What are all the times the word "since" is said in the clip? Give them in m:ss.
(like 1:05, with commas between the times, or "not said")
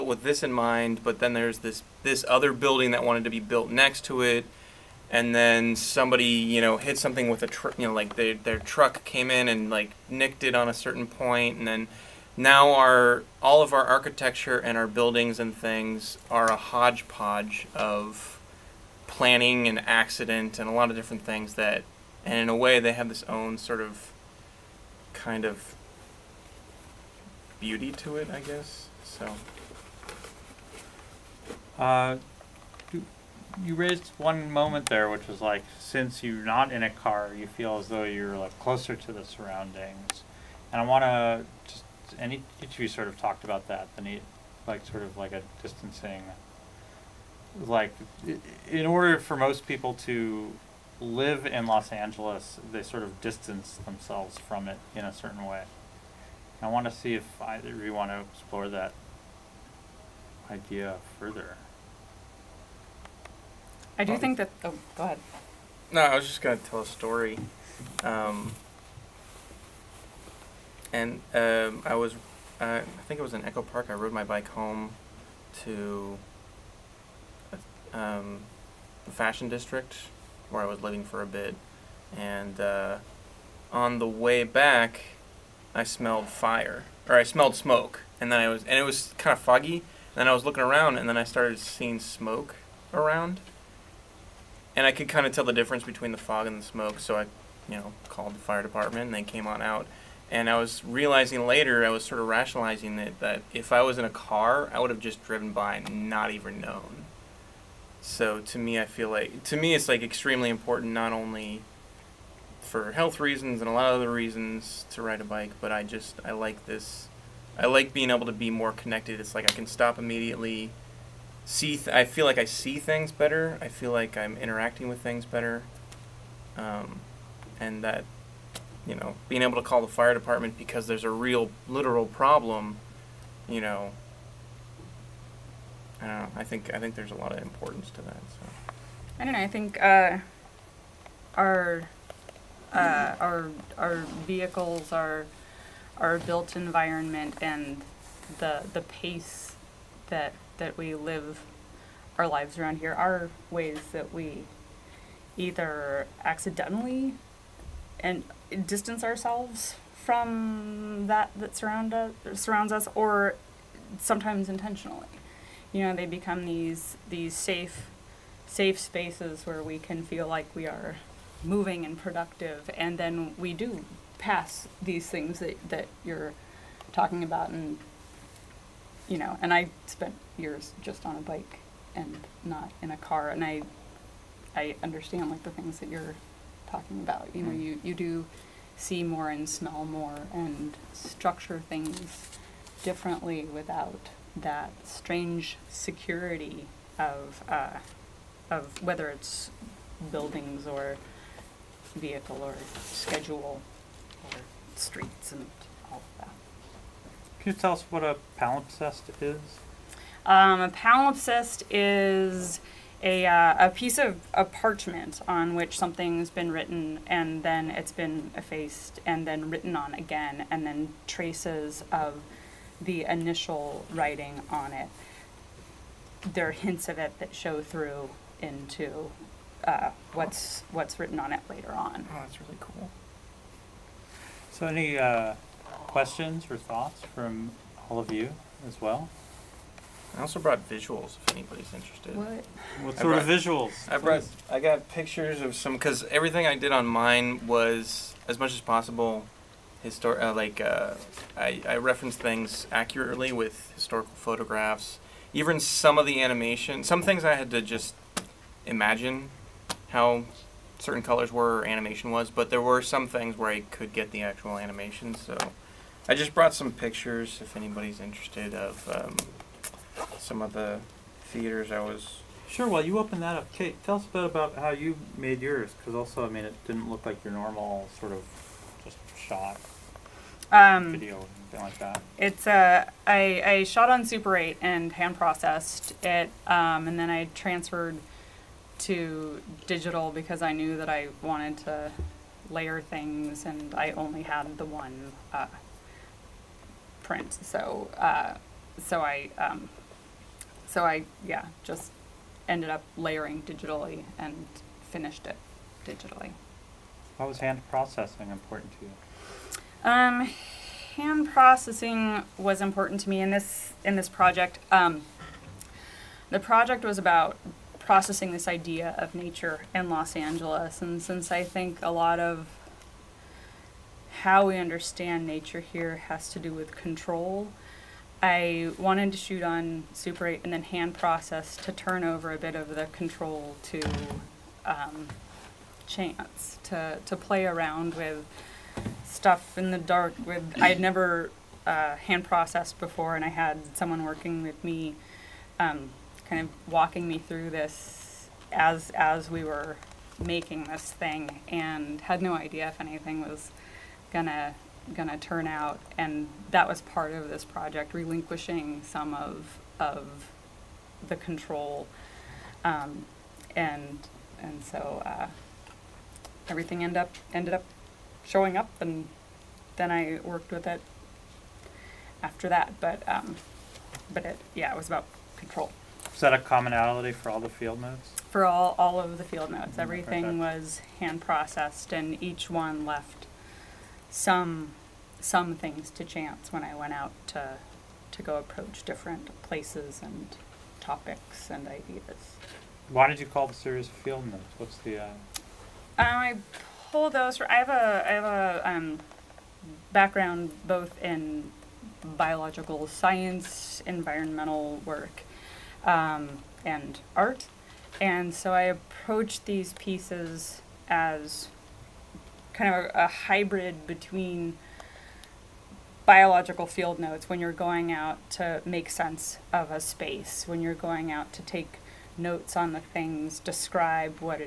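0:35, 5:21.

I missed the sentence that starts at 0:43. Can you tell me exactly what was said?
The need, like sort of like a distancing.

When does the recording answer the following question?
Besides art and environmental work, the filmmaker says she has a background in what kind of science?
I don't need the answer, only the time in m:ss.
6:42.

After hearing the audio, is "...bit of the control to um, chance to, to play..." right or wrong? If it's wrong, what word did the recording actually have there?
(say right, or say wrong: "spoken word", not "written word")
right.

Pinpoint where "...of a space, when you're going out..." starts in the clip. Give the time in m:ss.
6:59.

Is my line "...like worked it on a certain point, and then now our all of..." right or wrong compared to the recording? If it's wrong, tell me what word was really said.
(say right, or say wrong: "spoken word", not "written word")
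wrong: "nicked", not "worked".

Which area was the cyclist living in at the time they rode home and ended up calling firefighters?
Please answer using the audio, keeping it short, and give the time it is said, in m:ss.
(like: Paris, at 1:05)
Fashion District, at 1:19.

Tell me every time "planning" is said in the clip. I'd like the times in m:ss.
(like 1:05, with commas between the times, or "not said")
0:19.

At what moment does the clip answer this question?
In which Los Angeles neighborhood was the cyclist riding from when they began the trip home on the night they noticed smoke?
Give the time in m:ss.
1:13.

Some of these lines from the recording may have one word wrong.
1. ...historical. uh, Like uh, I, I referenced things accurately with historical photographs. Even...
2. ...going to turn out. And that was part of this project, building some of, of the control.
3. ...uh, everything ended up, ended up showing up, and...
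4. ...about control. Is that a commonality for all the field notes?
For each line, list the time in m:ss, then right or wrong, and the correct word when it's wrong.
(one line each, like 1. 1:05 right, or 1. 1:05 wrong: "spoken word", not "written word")
1. 4:09 right
2. 5:54 wrong: "relinquishing", not "building"
3. 6:05 right
4. 6:14 right.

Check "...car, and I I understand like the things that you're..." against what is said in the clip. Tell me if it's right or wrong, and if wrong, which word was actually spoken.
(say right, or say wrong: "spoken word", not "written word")
right.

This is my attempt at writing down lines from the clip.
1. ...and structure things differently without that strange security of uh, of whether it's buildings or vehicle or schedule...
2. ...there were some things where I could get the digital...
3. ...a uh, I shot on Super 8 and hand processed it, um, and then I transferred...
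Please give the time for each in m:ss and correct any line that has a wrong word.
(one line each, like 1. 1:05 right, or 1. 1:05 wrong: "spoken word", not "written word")
1. 3:10 right
2. 4:22 wrong: "actual", not "digital"
3. 4:42 right.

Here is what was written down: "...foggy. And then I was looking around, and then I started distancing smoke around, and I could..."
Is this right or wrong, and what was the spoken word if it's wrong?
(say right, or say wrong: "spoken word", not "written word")
wrong: "seeing", not "distancing".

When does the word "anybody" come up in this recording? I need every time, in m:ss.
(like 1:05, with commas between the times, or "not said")
4:01, 4:27.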